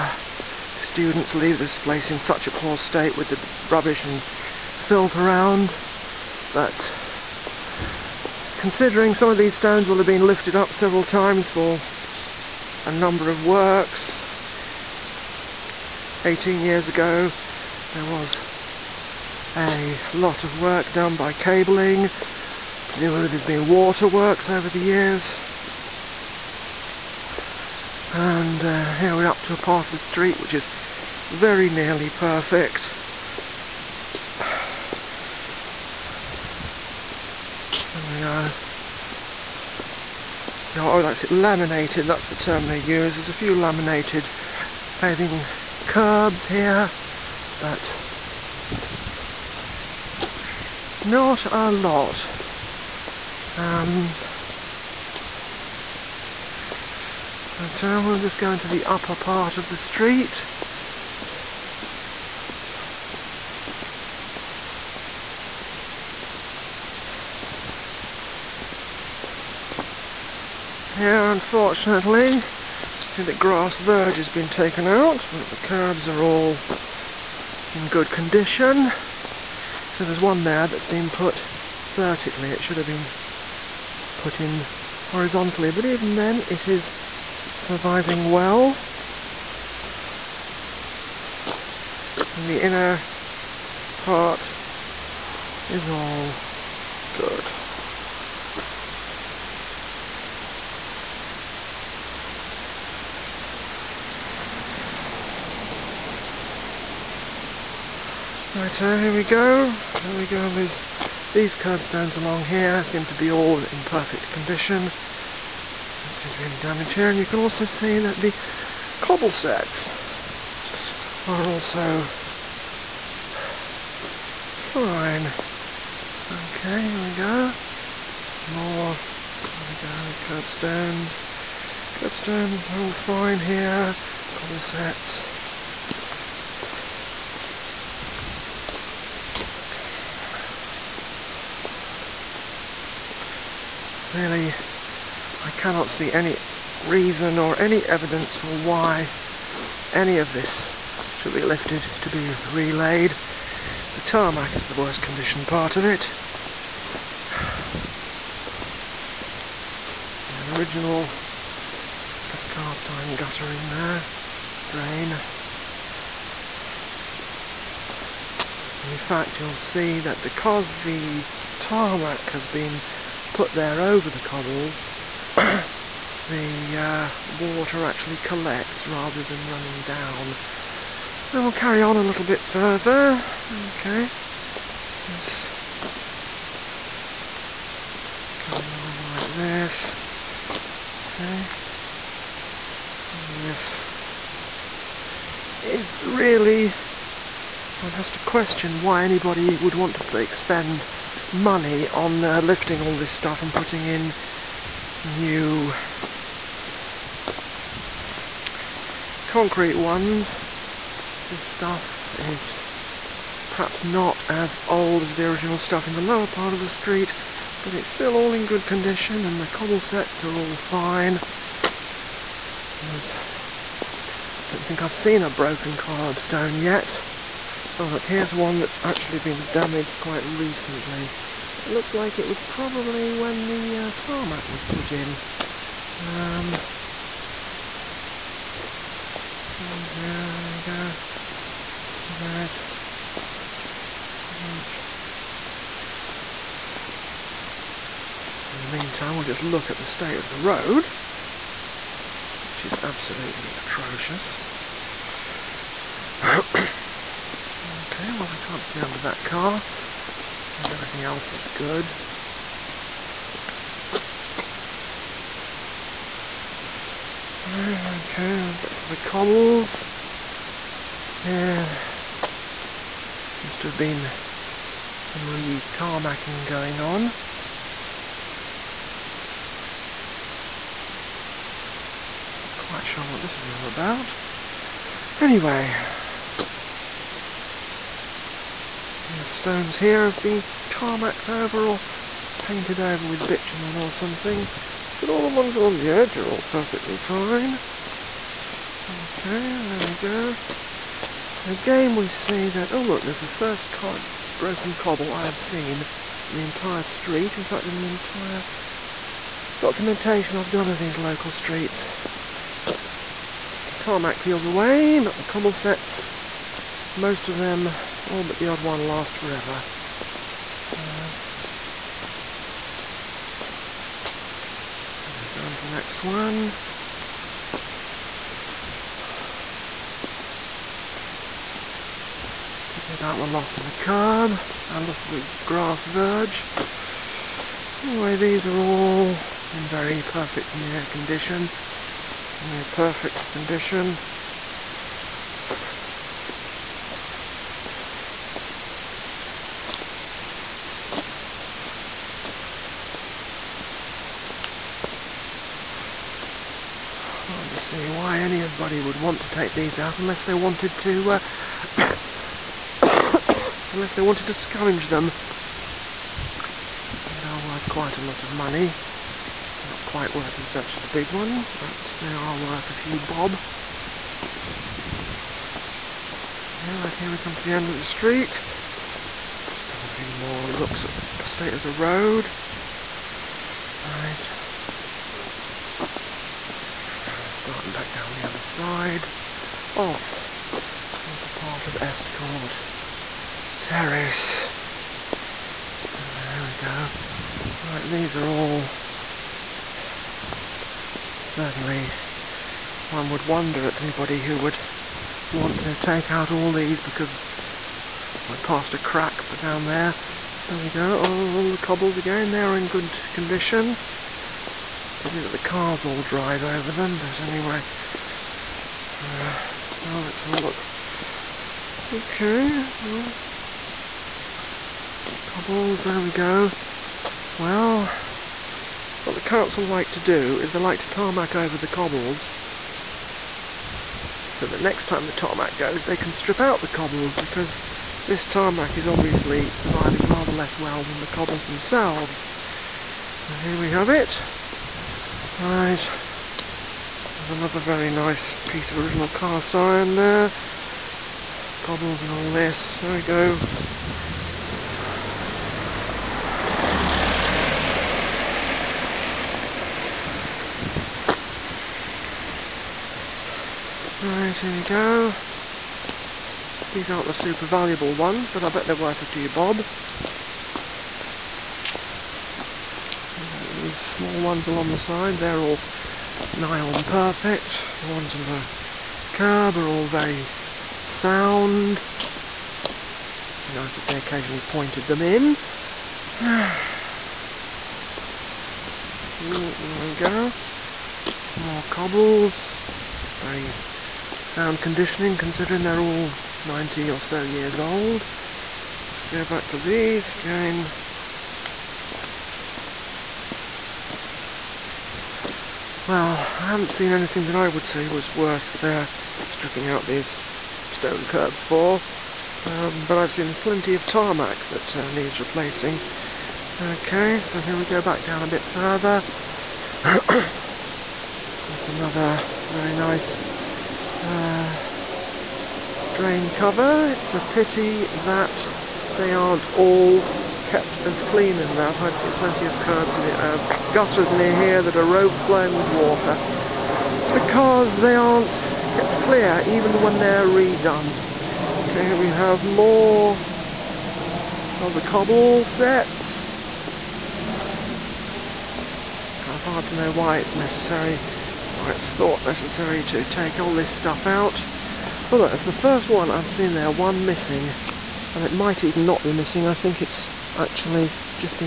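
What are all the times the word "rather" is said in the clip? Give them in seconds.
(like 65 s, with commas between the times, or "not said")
178 s, 440 s.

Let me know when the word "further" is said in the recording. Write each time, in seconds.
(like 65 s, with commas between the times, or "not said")
182 s, 518 s.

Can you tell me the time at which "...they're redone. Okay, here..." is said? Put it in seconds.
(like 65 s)
539 s.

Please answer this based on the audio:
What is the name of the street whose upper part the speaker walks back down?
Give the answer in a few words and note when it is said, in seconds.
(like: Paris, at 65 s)
Estcourt Terrace, at 391 s.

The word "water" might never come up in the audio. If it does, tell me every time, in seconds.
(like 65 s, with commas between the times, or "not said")
23 s, 177 s, 535 s.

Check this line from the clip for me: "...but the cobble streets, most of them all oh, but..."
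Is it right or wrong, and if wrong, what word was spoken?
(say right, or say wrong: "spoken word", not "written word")
wrong: "setts", not "streets".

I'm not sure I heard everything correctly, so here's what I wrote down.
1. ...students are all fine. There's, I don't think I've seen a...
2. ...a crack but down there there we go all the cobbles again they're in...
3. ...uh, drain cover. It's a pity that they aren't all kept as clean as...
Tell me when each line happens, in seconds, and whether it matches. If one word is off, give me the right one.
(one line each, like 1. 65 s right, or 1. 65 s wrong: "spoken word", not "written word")
1. 219 s wrong: "setts", not "students"
2. 408 s right
3. 524 s right.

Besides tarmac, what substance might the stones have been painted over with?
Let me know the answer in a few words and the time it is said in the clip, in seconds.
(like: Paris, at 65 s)
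bitumen, at 293 s.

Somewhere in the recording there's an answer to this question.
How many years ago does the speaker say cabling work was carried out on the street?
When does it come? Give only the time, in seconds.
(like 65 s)
16 s.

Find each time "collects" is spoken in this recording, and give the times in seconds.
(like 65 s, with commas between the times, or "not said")
178 s.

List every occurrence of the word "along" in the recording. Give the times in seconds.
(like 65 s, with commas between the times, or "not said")
112 s, 295 s, 474 s.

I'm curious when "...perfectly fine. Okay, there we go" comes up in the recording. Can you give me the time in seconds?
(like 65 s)
296 s.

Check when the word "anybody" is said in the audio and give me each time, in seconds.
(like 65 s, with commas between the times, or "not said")
199 s, 358 s, 403 s.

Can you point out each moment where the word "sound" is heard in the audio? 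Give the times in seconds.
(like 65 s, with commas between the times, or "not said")
480 s, 494 s.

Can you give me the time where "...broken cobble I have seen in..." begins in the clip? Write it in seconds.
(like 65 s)
304 s.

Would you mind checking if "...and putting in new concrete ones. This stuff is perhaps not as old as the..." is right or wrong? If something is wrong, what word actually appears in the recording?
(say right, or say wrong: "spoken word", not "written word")
right.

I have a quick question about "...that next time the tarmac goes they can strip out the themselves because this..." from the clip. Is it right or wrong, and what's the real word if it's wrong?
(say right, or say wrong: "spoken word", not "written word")
wrong: "cobbles", not "themselves".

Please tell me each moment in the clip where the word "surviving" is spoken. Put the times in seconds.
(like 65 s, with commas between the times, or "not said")
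87 s, 439 s.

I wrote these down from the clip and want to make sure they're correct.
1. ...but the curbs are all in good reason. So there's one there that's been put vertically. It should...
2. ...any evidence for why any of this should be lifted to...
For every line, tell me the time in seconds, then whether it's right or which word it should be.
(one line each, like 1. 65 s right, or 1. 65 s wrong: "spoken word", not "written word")
1. 75 s wrong: "condition", not "reason"
2. 147 s right.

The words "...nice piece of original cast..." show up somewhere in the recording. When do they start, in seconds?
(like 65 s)
447 s.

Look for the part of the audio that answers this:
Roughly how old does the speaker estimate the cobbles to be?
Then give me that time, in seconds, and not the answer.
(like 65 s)
496 s.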